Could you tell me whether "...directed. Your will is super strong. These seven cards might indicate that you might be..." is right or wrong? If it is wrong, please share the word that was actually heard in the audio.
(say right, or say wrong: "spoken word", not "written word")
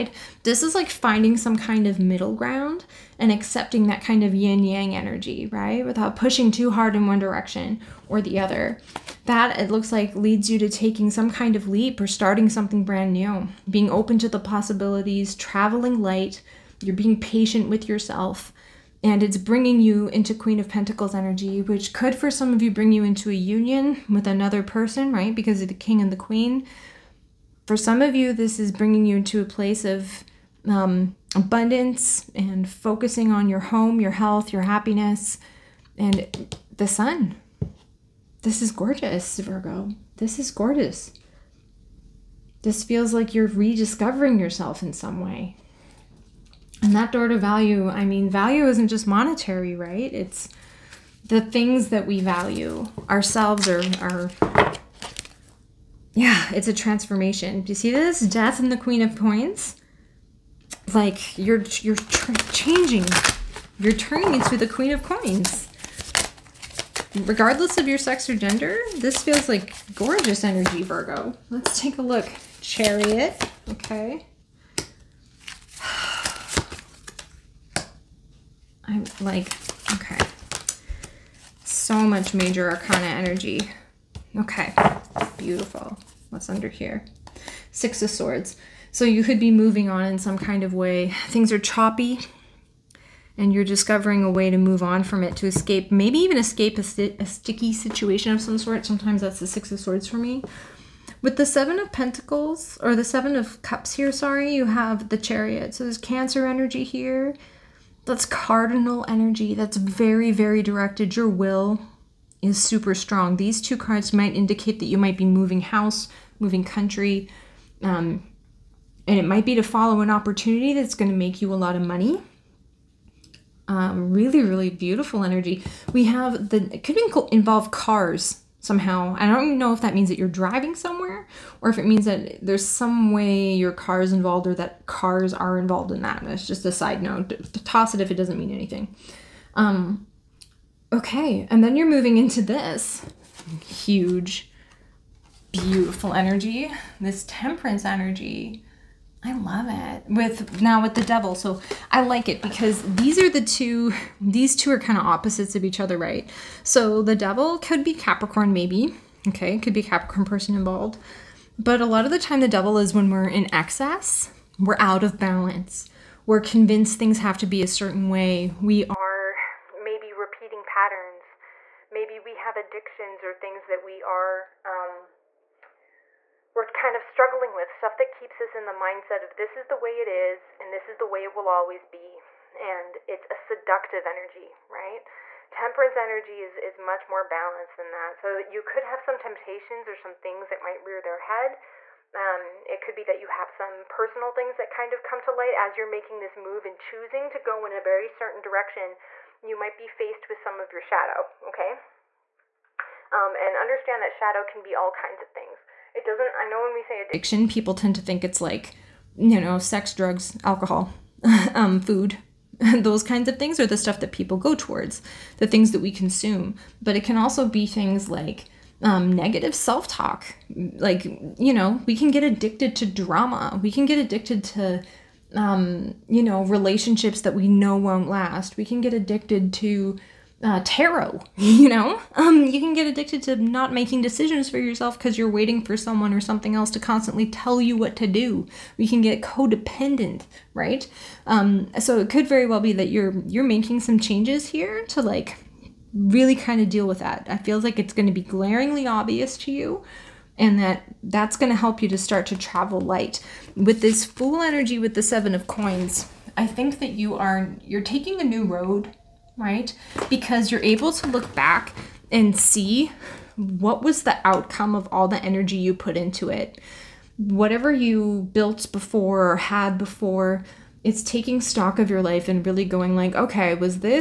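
wrong: "two", not "seven".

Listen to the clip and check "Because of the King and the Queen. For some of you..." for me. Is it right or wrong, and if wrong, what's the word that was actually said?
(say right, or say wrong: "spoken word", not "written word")
right.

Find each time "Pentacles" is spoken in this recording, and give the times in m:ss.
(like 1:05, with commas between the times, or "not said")
0:20, 1:41.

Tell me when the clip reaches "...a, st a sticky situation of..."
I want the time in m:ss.
1:36.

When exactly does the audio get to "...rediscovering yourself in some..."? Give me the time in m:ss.
0:43.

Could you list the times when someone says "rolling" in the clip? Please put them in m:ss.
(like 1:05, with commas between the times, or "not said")
not said.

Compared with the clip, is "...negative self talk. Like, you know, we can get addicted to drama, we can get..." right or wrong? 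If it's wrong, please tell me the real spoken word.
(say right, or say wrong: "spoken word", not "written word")
right.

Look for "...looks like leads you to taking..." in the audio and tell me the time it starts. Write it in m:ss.
0:09.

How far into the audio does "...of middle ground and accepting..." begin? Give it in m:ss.
0:01.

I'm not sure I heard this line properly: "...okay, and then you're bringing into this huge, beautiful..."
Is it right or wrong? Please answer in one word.
wrong.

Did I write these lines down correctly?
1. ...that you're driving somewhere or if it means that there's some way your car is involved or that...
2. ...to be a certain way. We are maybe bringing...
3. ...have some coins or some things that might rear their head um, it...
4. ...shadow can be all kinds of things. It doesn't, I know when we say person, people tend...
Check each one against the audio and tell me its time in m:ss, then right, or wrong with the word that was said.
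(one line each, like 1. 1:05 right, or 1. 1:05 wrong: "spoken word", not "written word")
1. 2:10 right
2. 2:47 wrong: "repeating", not "bringing"
3. 3:08 wrong: "temptations", not "coins"
4. 3:24 wrong: "addiction", not "person".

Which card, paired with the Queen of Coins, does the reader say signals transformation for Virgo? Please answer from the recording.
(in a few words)
Death.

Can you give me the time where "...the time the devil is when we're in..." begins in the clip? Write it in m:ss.
2:42.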